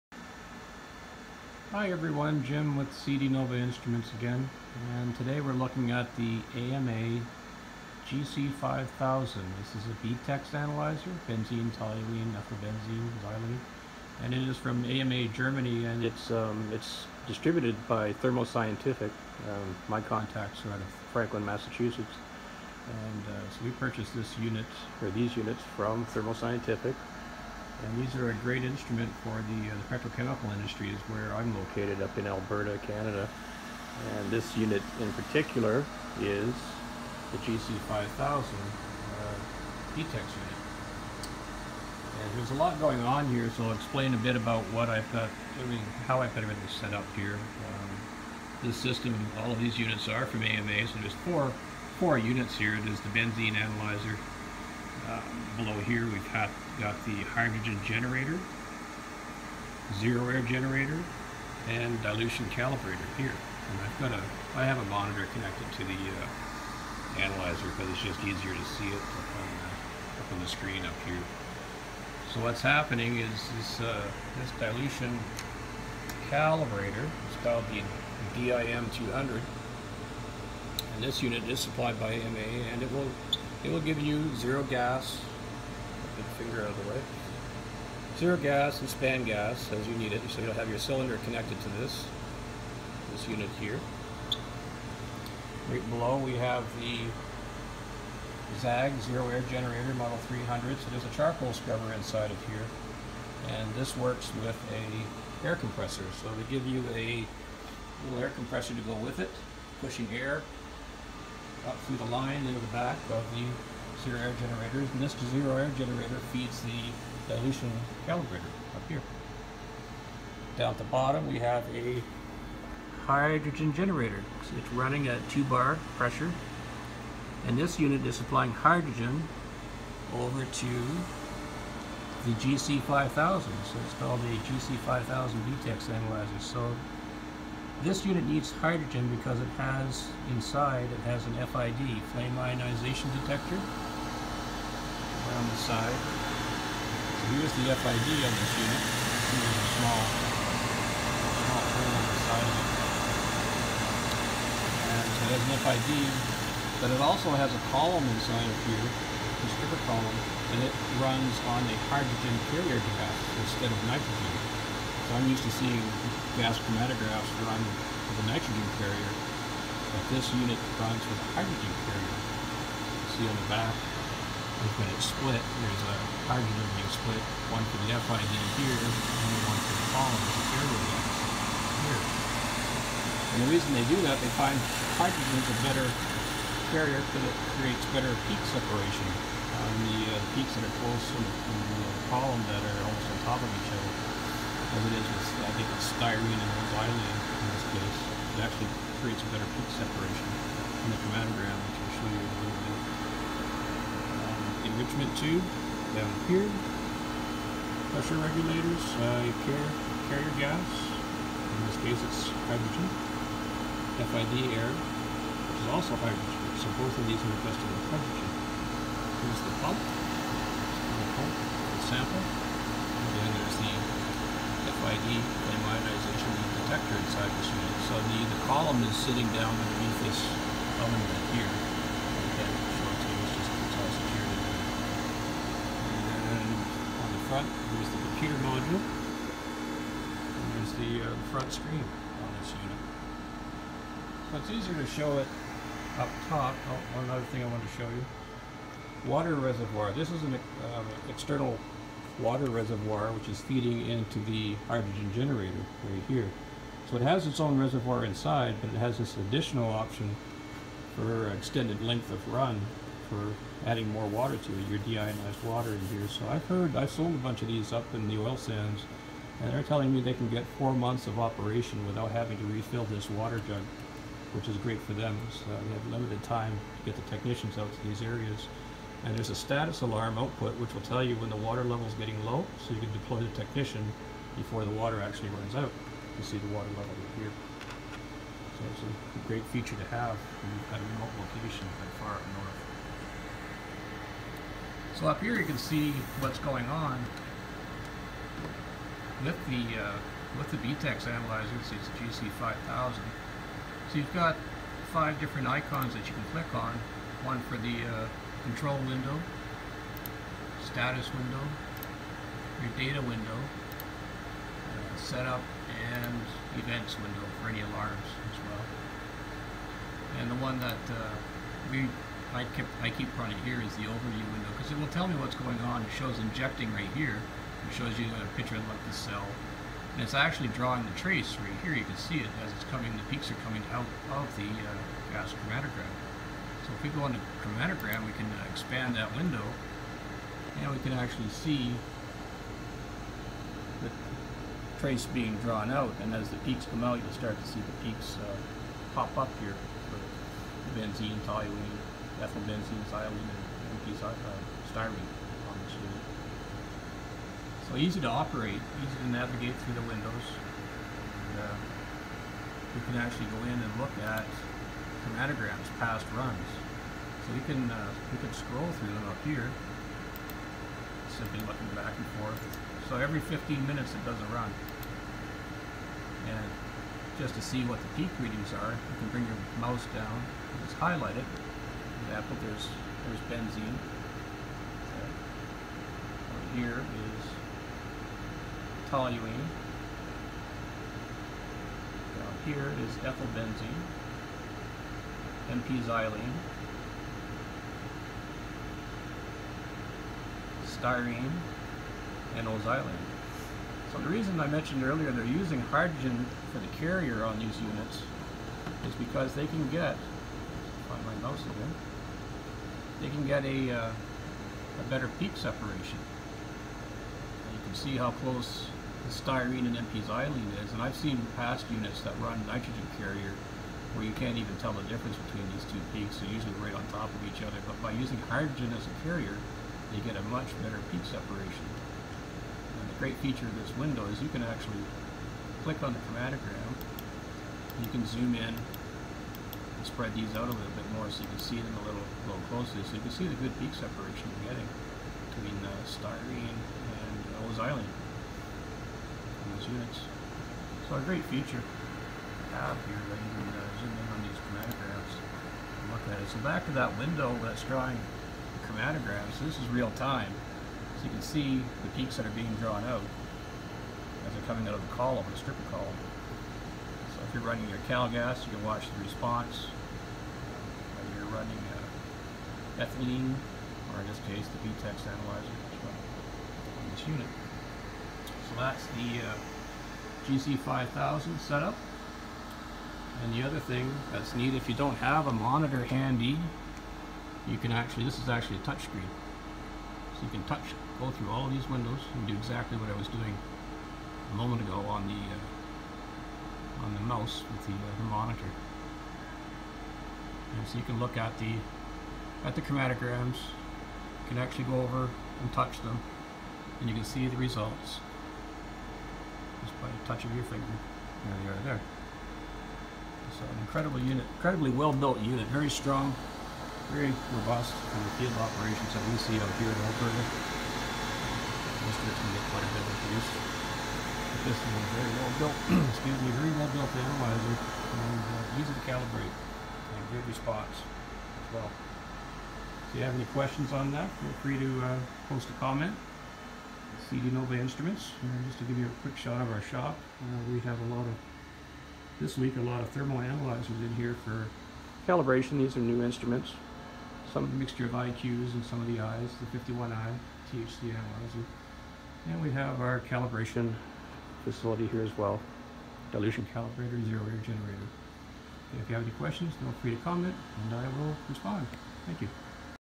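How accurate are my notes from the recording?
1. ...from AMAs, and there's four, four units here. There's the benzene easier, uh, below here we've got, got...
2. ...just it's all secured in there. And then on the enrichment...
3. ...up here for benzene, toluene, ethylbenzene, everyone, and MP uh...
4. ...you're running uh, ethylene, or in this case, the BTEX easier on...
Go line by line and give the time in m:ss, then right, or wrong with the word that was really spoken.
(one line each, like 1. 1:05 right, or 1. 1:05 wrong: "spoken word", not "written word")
1. 0:50 wrong: "analyzer", not "easier"
2. 3:53 wrong: "front", not "enrichment"
3. 5:49 wrong: "xylene", not "everyone"
4. 7:51 wrong: "analyzer", not "easier".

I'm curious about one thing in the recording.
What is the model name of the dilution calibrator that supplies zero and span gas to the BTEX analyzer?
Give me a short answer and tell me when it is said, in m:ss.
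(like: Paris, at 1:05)
DIM200, at 1:18.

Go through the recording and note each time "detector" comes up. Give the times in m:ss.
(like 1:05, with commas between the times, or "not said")
2:23, 3:44.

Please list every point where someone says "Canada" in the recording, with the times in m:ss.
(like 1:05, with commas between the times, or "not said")
0:32.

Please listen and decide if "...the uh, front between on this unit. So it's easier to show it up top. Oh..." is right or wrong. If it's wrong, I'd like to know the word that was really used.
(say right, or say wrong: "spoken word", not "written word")
wrong: "screen", not "between".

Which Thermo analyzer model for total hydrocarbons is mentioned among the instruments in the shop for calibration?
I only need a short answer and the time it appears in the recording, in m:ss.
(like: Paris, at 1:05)
51i, at 9:09.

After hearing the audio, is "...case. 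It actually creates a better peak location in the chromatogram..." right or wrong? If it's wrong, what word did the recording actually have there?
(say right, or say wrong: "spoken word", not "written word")
wrong: "separation", not "location".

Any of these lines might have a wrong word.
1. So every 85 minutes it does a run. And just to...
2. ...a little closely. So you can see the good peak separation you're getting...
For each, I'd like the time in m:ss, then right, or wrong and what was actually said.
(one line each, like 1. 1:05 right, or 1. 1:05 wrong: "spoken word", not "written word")
1. 6:12 wrong: "15", not "85"
2. 7:22 right.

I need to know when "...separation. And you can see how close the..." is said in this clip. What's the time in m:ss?
6:55.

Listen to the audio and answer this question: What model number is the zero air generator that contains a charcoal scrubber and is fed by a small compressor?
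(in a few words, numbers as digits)
300.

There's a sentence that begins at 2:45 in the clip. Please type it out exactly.
So I'm used to seeing gas chromatographs run with a nitrogen carrier, but this unit runs with a hydrogen carrier.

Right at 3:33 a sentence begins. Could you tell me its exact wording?
FID air, which is also hydrogen, so both of these are invested with hydrogen.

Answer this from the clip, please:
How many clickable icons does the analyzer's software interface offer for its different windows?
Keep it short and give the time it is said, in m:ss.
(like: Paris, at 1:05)
5, at 5:04.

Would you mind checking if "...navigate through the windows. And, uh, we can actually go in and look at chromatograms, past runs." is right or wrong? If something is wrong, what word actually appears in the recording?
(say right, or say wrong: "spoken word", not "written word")
right.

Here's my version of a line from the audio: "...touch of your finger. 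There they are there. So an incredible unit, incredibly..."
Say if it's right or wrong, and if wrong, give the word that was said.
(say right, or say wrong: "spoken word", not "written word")
right.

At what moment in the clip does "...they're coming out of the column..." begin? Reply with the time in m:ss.
7:44.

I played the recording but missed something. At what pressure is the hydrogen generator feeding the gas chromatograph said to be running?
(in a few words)
2 bar.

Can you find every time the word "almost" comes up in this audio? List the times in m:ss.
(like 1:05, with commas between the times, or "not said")
3:12.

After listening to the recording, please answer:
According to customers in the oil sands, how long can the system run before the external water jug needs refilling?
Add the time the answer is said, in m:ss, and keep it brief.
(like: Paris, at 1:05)
4 months, at 4:30.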